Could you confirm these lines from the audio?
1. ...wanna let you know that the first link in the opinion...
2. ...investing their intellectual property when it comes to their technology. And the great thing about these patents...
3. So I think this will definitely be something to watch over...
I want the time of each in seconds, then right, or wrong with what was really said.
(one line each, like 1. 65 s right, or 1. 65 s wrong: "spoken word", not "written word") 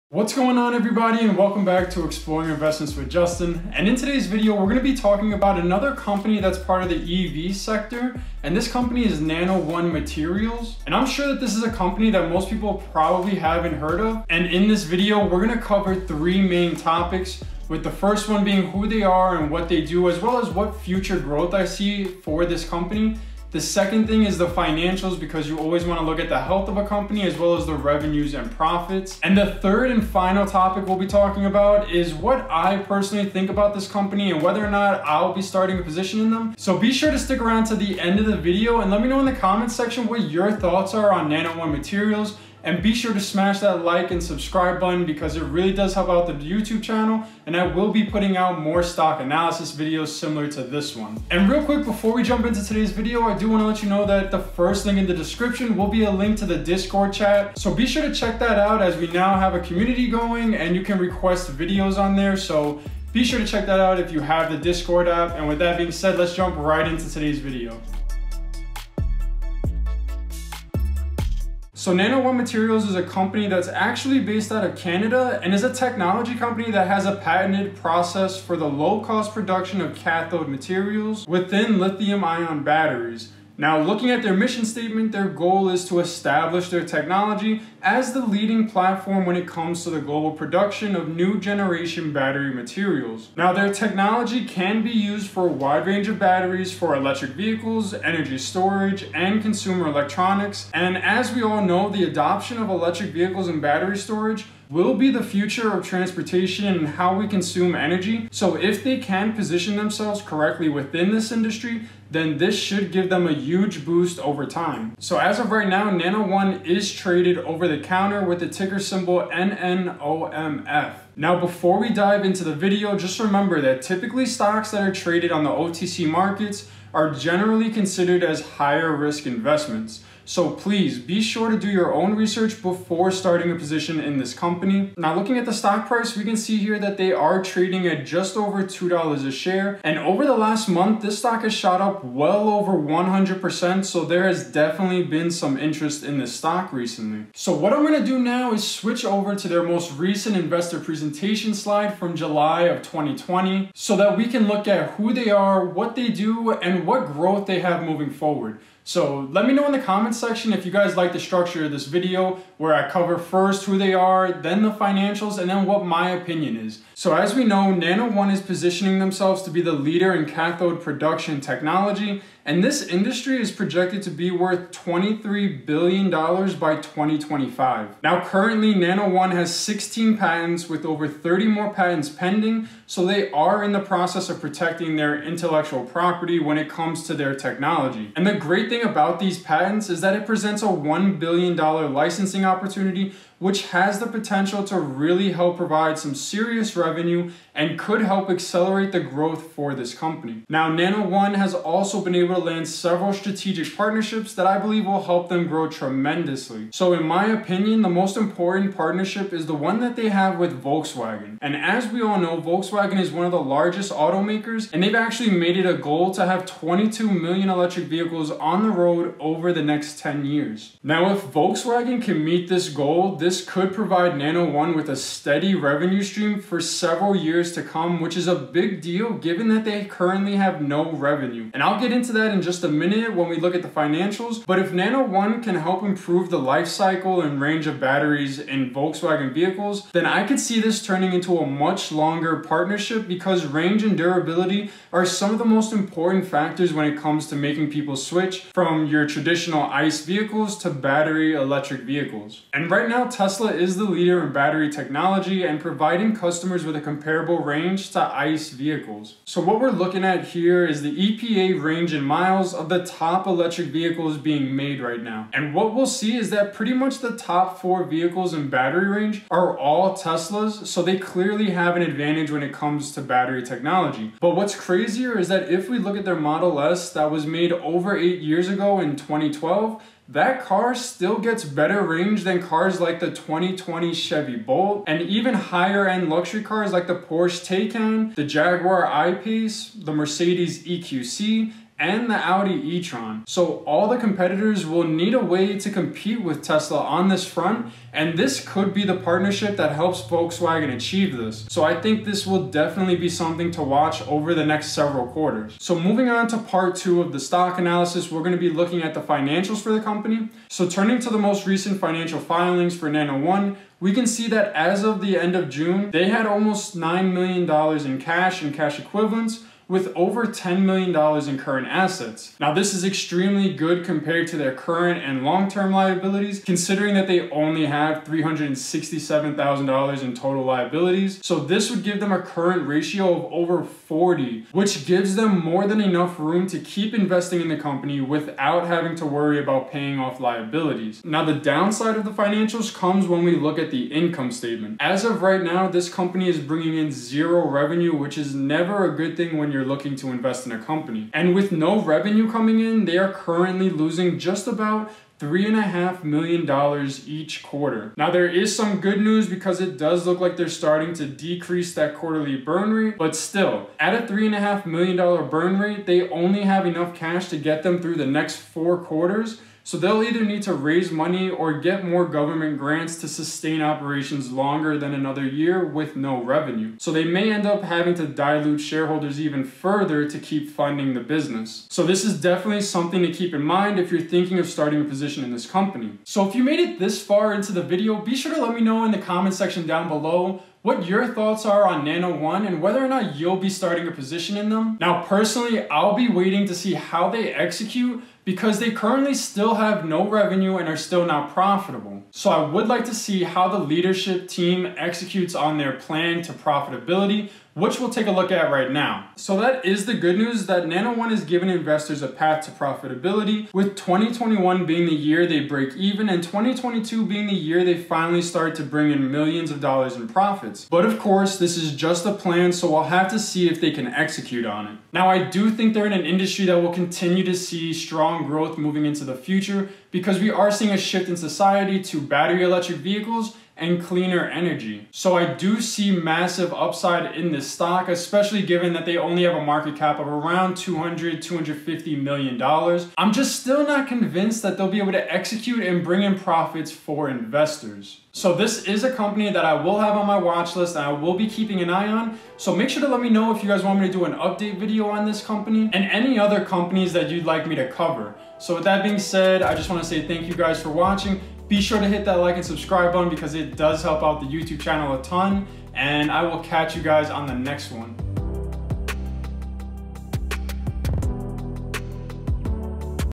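1. 53 s wrong: "description", not "opinion"
2. 184 s wrong: "protecting", not "investing"
3. 301 s right.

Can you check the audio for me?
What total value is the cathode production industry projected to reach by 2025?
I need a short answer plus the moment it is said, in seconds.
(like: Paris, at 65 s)
$23 billion, at 174 s.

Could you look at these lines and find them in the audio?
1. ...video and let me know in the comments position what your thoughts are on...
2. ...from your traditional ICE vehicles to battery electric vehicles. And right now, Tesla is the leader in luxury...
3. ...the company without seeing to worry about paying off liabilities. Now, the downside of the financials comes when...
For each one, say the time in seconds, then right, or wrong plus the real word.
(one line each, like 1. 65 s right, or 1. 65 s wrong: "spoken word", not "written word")
1. 38 s wrong: "section", not "position"
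2. 248 s wrong: "battery", not "luxury"
3. 337 s wrong: "having", not "seeing".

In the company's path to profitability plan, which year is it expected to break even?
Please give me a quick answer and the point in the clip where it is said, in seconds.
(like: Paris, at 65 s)
2021, at 413 s.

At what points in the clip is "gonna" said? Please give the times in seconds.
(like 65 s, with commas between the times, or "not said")
4 s, 15 s, 147 s, 308 s.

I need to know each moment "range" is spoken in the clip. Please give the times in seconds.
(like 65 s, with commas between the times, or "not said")
95 s, 237 s, 243 s, 257 s, 261 s, 268 s, 281 s.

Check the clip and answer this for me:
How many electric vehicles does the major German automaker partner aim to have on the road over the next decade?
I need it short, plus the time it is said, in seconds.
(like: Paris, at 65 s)
22 million, at 216 s.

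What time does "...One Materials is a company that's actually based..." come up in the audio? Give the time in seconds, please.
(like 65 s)
72 s.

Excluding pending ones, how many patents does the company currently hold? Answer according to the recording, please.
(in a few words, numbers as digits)
16.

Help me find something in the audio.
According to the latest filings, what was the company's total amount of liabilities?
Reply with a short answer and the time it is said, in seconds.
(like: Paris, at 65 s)
$367,000, at 328 s.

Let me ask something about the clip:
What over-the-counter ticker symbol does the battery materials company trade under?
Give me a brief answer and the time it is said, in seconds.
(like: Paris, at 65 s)
NNOMF, at 119 s.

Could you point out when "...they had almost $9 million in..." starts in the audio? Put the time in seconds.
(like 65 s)
315 s.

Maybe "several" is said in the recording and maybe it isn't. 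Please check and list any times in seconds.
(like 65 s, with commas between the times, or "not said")
202 s, 226 s, 304 s.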